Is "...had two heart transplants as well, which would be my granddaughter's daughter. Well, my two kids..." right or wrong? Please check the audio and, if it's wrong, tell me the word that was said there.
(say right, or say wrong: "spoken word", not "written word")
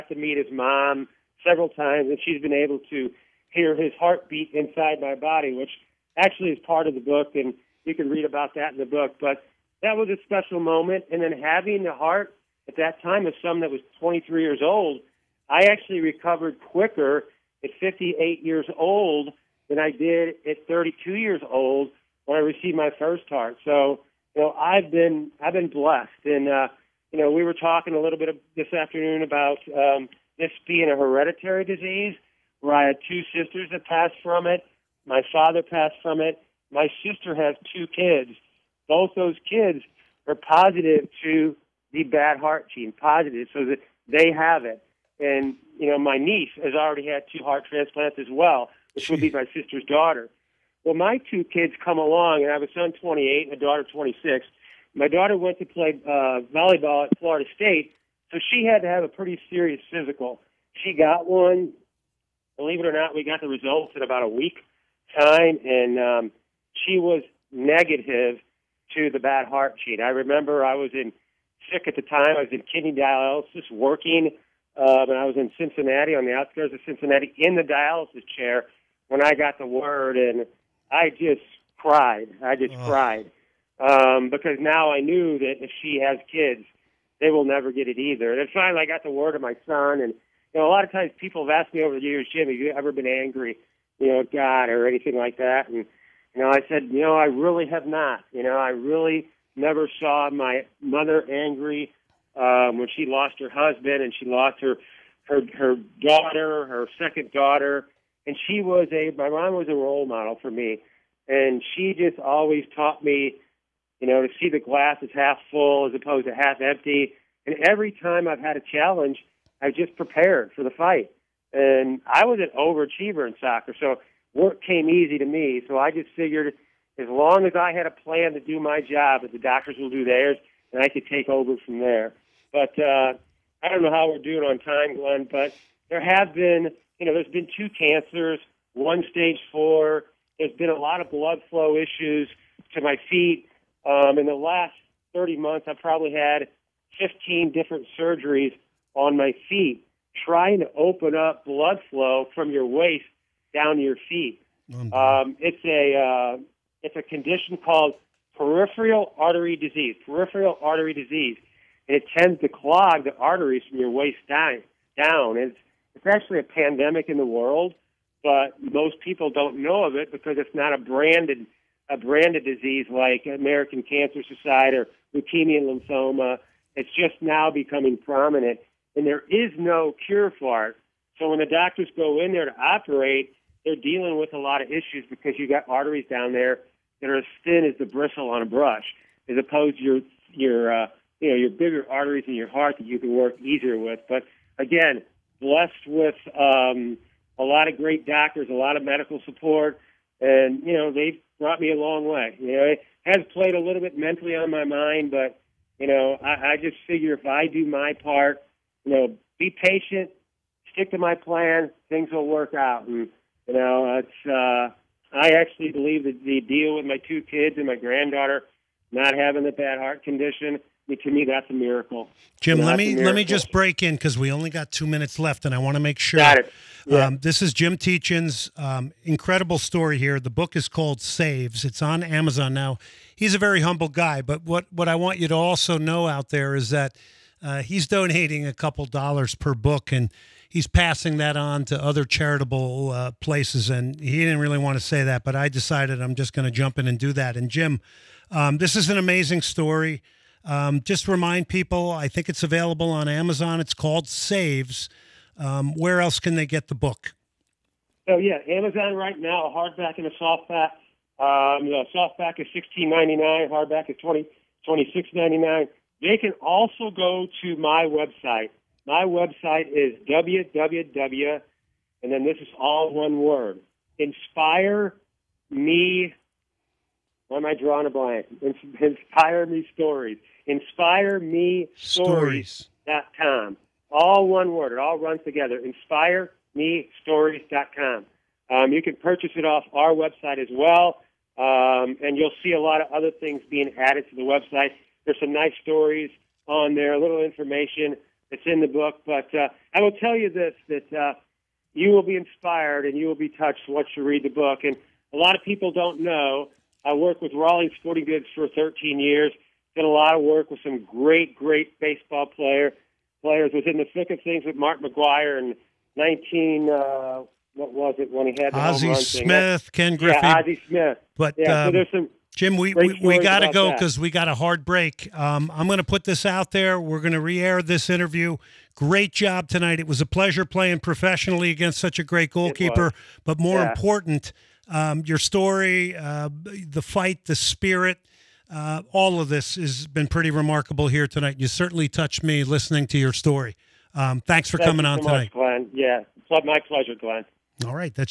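wrong: "sister", not "granddaughter".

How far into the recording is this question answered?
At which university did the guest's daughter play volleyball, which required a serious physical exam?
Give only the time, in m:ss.
0:57.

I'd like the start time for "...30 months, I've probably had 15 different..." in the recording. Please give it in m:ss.
2:25.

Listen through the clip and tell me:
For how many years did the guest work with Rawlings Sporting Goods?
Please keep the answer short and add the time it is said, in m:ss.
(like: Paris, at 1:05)
13, at 5:08.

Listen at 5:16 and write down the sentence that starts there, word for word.
Uh, what was it when he had the Ozzie Smith, thing.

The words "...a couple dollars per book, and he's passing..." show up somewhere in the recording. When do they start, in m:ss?
3:58.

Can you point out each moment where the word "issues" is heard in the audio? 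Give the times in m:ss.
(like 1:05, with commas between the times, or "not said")
2:21, 3:04.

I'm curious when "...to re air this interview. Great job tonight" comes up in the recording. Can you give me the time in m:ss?
5:27.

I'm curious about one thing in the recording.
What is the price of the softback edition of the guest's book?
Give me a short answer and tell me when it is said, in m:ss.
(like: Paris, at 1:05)
$16.99, at 4:22.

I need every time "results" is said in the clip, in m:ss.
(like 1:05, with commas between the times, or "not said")
1:03.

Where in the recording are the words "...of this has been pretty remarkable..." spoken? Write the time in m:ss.
5:39.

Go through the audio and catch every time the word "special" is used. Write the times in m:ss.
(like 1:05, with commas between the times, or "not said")
0:10.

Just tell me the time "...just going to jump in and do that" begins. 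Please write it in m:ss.
4:06.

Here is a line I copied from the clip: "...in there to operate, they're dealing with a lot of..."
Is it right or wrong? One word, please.
right.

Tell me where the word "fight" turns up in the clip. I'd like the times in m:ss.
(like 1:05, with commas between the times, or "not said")
2:00, 5:36.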